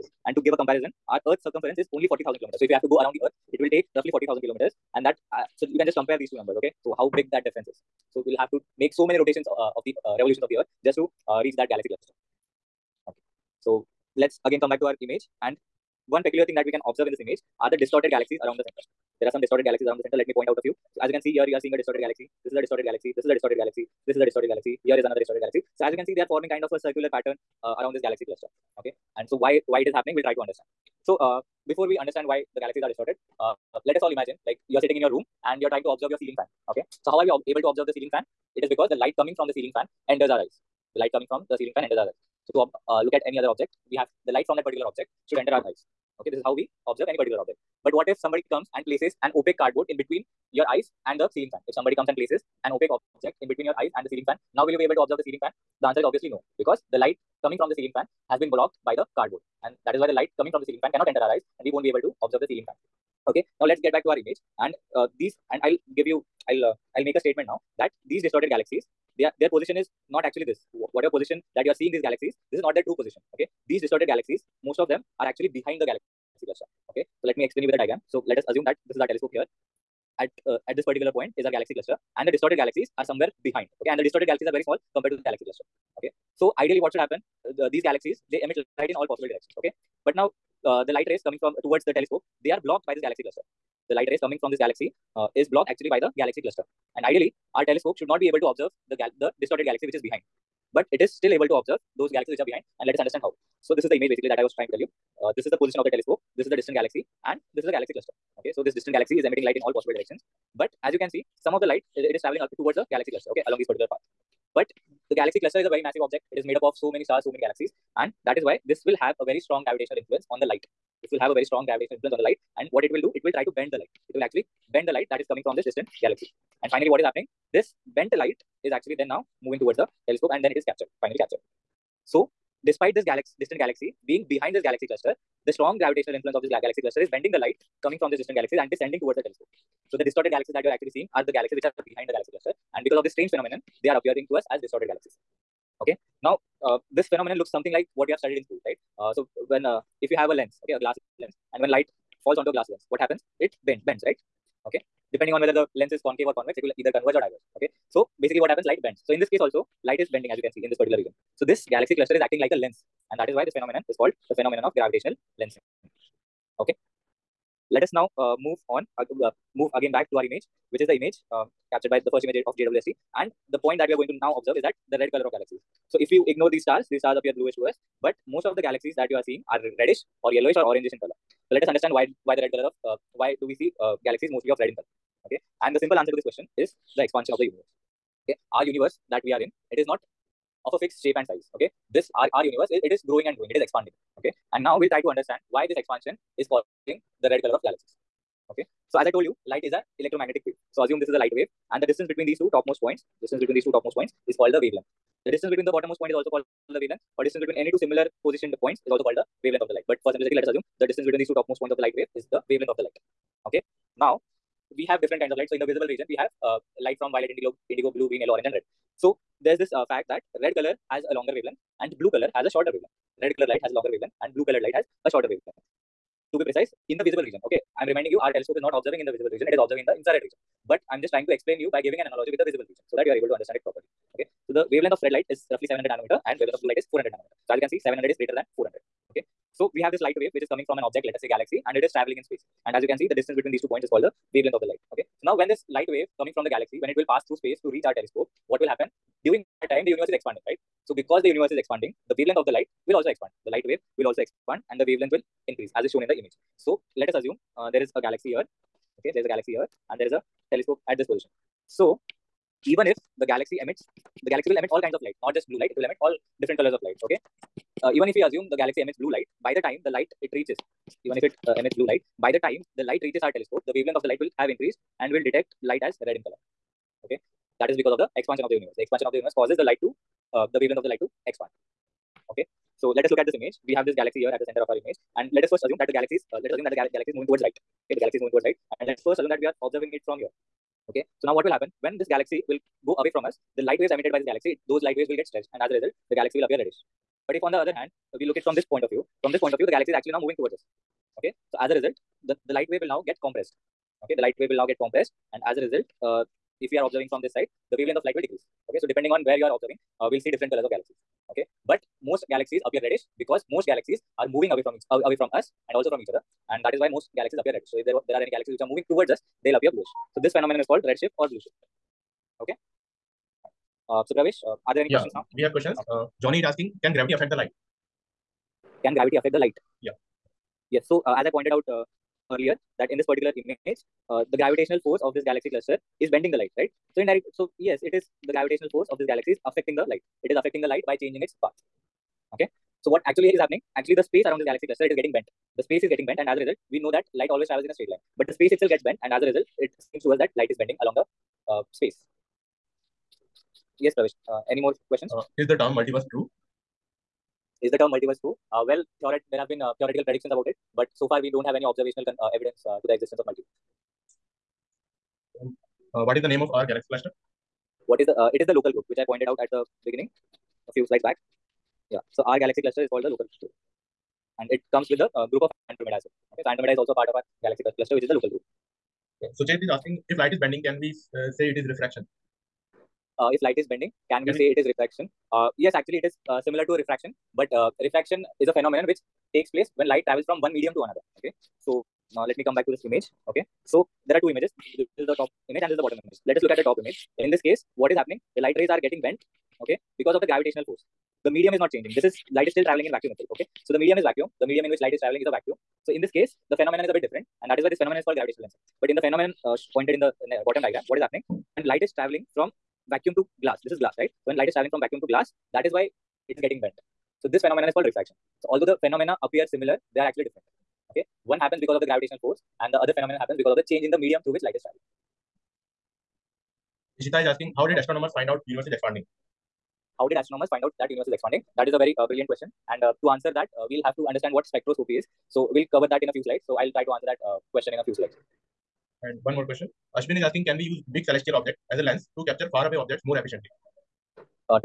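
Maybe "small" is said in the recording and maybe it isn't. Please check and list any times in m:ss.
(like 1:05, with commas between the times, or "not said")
1:24.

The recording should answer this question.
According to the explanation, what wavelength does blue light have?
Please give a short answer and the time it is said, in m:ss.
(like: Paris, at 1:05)
400 nanometers, at 3:56.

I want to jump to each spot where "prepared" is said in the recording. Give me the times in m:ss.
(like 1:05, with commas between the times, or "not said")
not said.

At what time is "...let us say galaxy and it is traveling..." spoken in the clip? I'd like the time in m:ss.
4:01.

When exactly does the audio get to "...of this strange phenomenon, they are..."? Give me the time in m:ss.
2:22.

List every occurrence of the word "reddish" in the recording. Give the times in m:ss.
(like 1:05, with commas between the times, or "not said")
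2:59, 4:56, 5:12, 5:17.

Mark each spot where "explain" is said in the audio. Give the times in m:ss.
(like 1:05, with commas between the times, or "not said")
1:17, 3:51.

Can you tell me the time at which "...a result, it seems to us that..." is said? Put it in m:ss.
5:49.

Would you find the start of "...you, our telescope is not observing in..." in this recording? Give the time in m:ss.
3:48.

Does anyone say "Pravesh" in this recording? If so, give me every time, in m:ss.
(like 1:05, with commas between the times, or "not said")
5:24, 5:53.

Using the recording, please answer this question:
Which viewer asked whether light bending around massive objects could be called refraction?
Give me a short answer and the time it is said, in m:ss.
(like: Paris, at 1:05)
Jay, at 6:19.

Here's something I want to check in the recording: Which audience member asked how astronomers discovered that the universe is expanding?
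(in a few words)
Ishita.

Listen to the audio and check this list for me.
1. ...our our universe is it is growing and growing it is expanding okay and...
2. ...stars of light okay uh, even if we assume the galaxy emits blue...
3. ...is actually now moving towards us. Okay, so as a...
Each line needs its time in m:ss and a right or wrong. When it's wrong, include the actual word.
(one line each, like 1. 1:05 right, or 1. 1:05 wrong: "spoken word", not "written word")
1. 3:12 right
2. 4:26 wrong: "colors", not "stars"
3. 4:59 right.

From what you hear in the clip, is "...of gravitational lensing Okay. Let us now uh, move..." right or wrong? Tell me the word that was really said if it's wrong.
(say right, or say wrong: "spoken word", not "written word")
right.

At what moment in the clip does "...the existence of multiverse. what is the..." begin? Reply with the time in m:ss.
6:02.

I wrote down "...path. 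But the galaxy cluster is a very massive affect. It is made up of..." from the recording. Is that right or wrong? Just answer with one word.
wrong.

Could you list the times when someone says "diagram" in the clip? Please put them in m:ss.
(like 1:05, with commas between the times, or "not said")
1:17, 6:50.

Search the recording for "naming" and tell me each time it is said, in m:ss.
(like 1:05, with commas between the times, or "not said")
not said.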